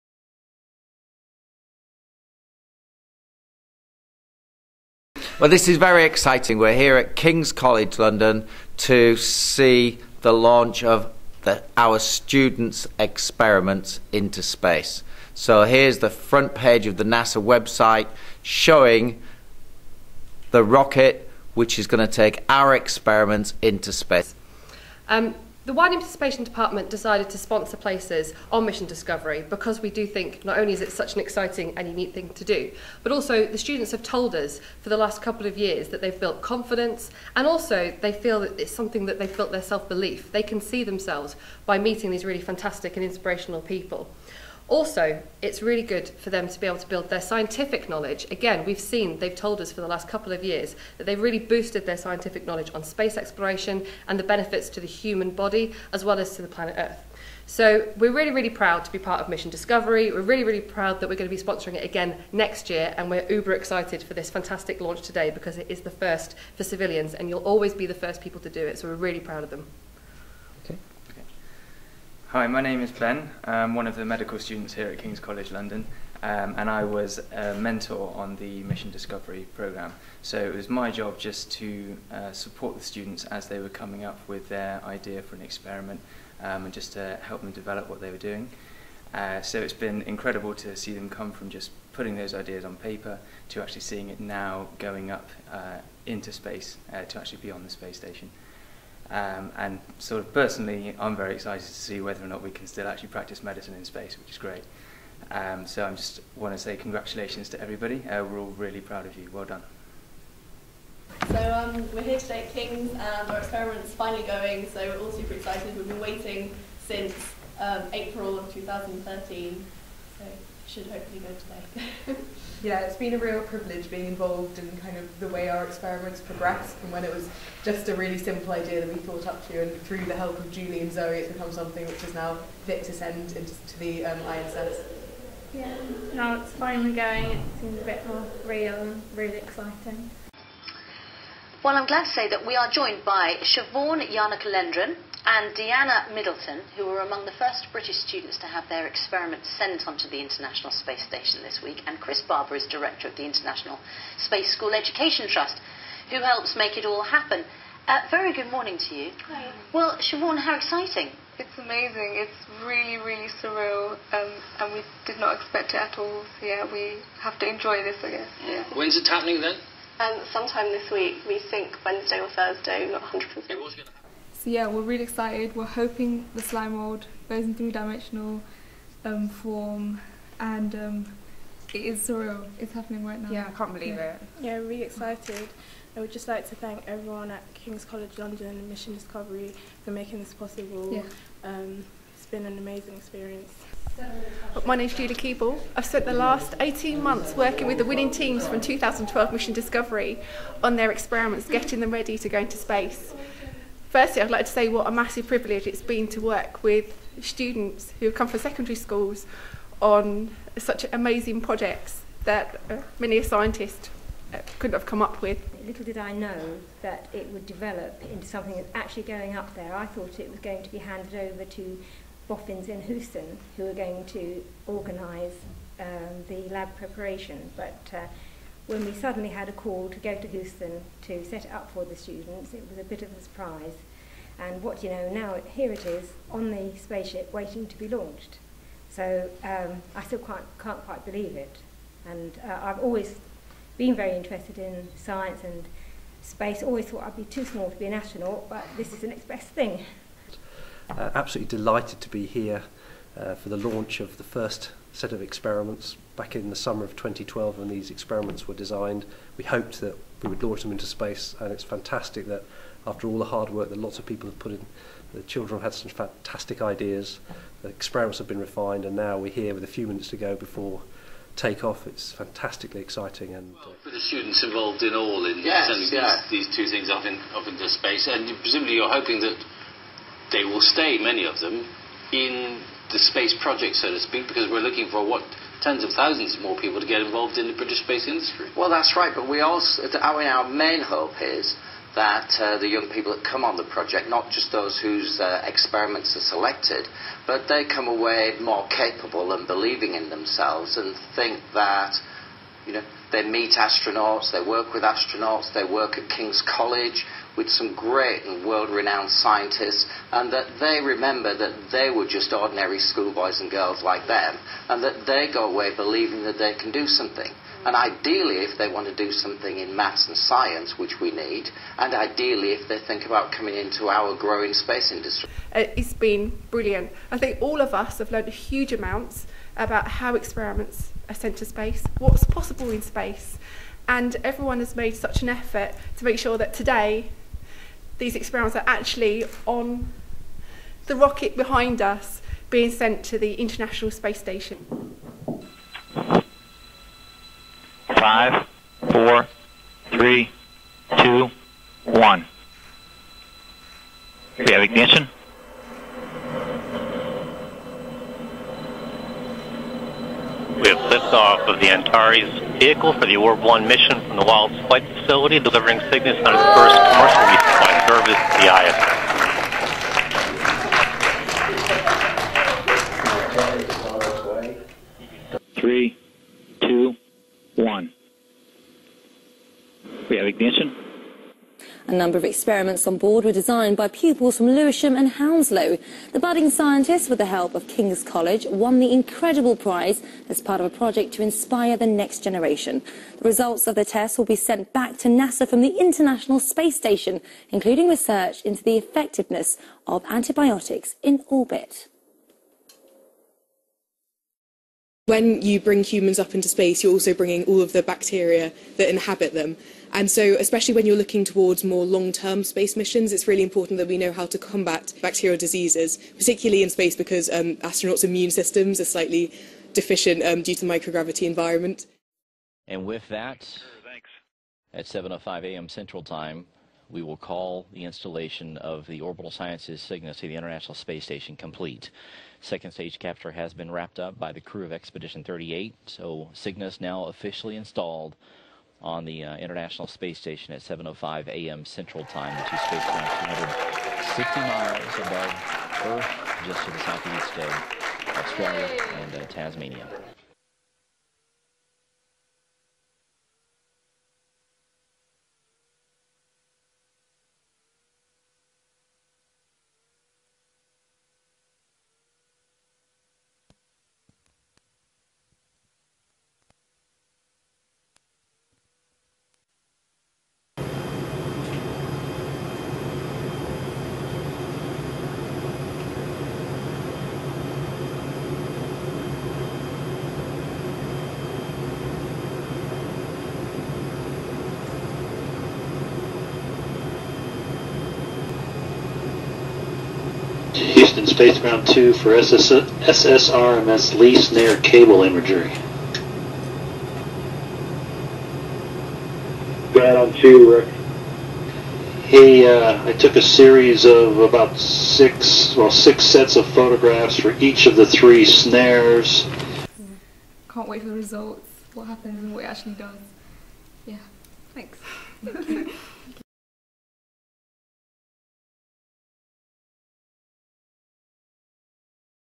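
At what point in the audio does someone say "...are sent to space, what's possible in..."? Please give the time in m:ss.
5:31.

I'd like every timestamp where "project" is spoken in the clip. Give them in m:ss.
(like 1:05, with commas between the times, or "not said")
3:31, 4:43, 4:53, 6:30.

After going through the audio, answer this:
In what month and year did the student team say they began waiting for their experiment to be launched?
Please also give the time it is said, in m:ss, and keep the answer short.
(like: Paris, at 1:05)
April 2013, at 1:57.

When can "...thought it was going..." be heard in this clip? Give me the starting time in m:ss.
3:39.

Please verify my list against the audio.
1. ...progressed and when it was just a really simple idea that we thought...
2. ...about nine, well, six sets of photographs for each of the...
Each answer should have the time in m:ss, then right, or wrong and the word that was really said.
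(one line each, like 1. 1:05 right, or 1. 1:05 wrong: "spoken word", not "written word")
1. 2:06 right
2. 8:24 wrong: "six", not "nine".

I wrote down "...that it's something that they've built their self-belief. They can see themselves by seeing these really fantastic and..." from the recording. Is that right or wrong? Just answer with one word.
wrong.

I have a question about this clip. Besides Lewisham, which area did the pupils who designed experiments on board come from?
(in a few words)
Hounslow.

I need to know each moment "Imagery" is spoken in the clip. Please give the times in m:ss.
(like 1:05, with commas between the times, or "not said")
8:15.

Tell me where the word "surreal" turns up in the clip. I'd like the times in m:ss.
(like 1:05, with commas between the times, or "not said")
2:43, 3:02.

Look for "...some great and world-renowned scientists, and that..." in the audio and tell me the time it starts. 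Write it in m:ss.
5:07.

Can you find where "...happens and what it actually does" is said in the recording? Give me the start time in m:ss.
8:31.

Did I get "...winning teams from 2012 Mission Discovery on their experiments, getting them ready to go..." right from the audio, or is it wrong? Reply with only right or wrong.
right.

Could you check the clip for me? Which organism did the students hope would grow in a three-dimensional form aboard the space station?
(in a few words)
Slime mold.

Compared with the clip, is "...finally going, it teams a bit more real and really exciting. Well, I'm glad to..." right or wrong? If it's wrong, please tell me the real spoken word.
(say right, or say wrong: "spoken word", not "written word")
wrong: "seems", not "teams".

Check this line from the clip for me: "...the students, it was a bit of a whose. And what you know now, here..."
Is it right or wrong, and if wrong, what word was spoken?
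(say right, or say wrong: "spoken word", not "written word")
wrong: "surprise", not "whose".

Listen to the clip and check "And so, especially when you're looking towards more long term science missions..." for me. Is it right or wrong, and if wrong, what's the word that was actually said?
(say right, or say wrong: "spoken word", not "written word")
wrong: "space", not "science".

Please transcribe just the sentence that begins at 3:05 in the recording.
I would just like to thank everyone at King's College London and Mission Discovery for making this possible.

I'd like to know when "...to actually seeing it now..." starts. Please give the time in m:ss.
1:33.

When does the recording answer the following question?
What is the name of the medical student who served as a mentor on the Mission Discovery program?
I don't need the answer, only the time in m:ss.
1:12.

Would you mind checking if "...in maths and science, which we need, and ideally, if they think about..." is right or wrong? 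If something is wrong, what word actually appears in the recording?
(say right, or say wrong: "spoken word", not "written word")
right.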